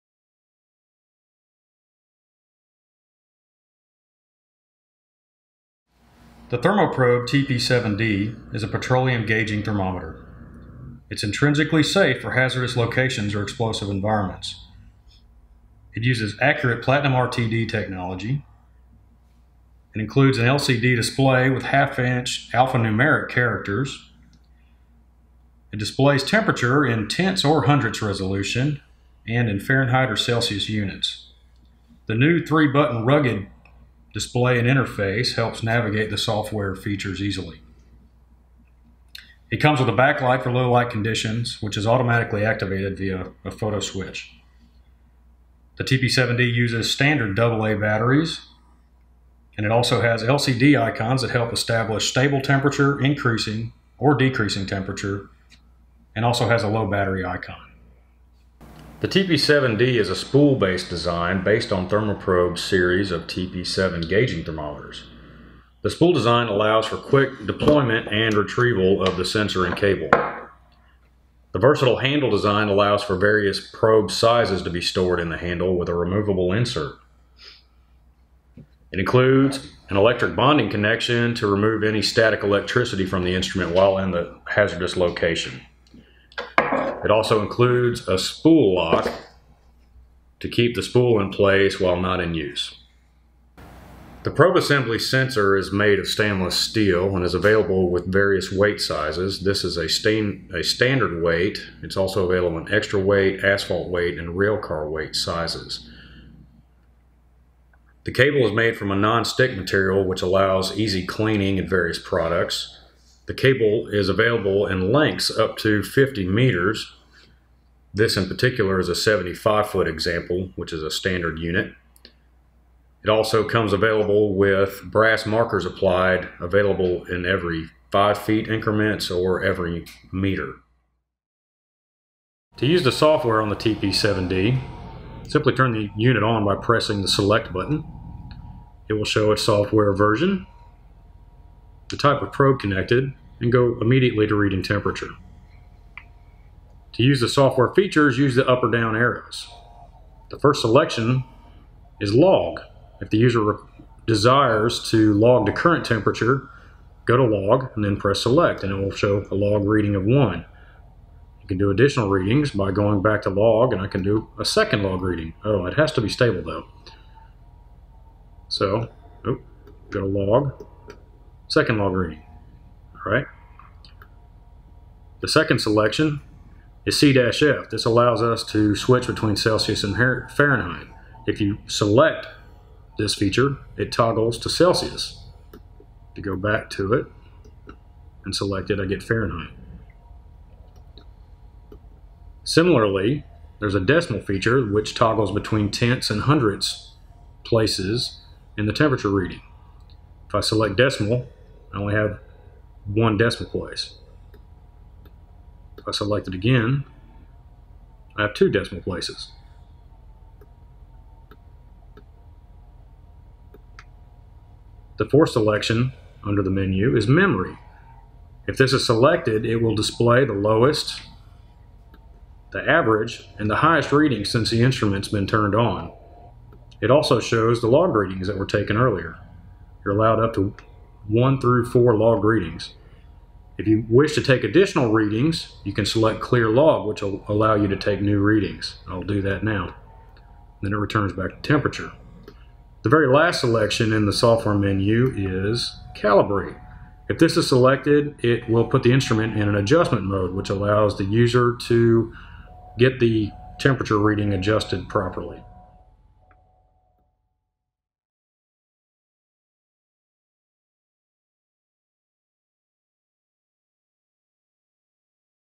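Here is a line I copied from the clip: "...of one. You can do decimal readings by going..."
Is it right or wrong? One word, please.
wrong.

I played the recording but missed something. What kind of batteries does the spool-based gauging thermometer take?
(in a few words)
AA batteries.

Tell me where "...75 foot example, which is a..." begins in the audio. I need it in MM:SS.
01:58.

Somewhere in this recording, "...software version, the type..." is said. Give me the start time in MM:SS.
02:19.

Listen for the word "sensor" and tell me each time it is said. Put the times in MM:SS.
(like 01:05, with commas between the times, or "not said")
01:09, 01:34.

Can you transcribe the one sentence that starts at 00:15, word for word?
It uses accurate platinum RTD technology.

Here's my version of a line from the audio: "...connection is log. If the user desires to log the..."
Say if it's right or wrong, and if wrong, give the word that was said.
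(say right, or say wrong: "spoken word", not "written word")
wrong: "selection", not "connection".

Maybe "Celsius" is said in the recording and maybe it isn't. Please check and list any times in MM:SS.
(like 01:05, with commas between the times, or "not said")
00:30, 02:59, 03:04.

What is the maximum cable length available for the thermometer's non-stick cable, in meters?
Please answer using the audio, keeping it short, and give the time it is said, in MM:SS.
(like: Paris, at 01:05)
50 meters, at 01:55.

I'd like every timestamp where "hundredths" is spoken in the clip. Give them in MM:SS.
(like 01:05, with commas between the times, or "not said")
00:27, 03:16.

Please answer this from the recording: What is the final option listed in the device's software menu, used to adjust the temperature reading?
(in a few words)
Calibrate.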